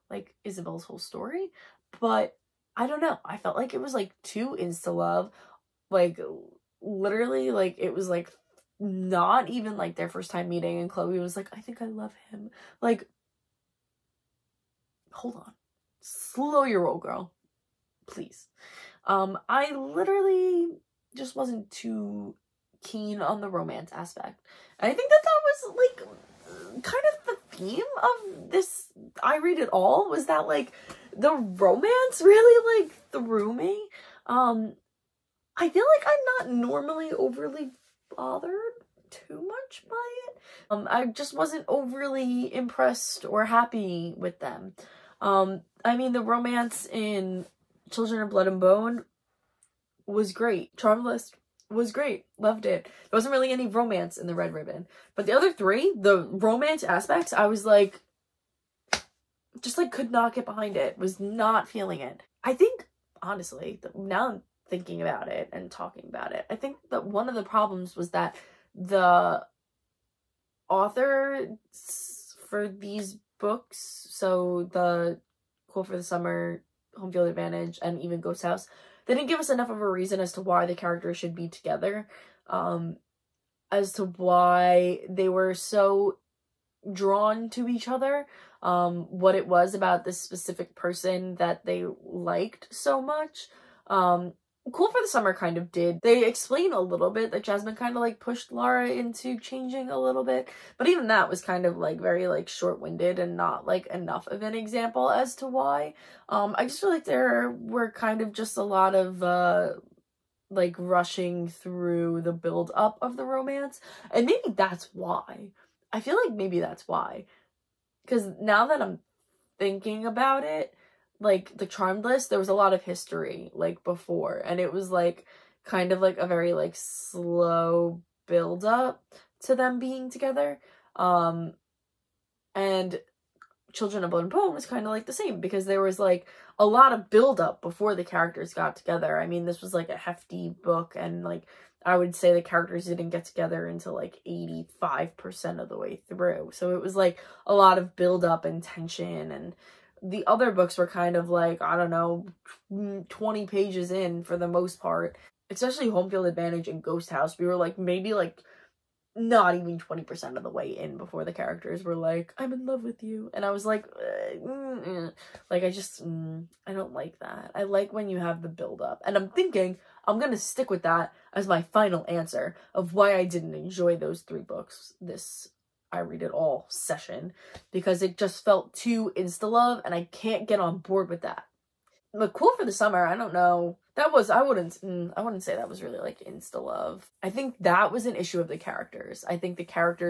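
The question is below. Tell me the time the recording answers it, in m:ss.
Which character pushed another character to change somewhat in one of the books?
1:37.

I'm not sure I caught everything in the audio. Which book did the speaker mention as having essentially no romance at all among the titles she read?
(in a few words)
The Red Ribbon.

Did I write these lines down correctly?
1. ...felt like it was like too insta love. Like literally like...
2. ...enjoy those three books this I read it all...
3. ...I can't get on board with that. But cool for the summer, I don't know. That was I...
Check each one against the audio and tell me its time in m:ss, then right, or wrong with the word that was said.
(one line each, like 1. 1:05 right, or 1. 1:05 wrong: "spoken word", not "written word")
1. 0:03 right
2. 2:53 right
3. 2:59 right.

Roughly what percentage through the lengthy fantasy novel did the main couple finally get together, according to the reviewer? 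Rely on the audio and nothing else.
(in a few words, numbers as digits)
85%.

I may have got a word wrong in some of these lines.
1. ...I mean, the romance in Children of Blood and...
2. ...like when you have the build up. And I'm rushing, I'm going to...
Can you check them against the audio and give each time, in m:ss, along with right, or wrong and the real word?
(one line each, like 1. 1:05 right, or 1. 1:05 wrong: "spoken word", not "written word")
1. 0:45 right
2. 2:47 wrong: "thinking", not "rushing".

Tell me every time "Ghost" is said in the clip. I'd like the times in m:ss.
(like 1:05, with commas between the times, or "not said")
1:18, 2:36.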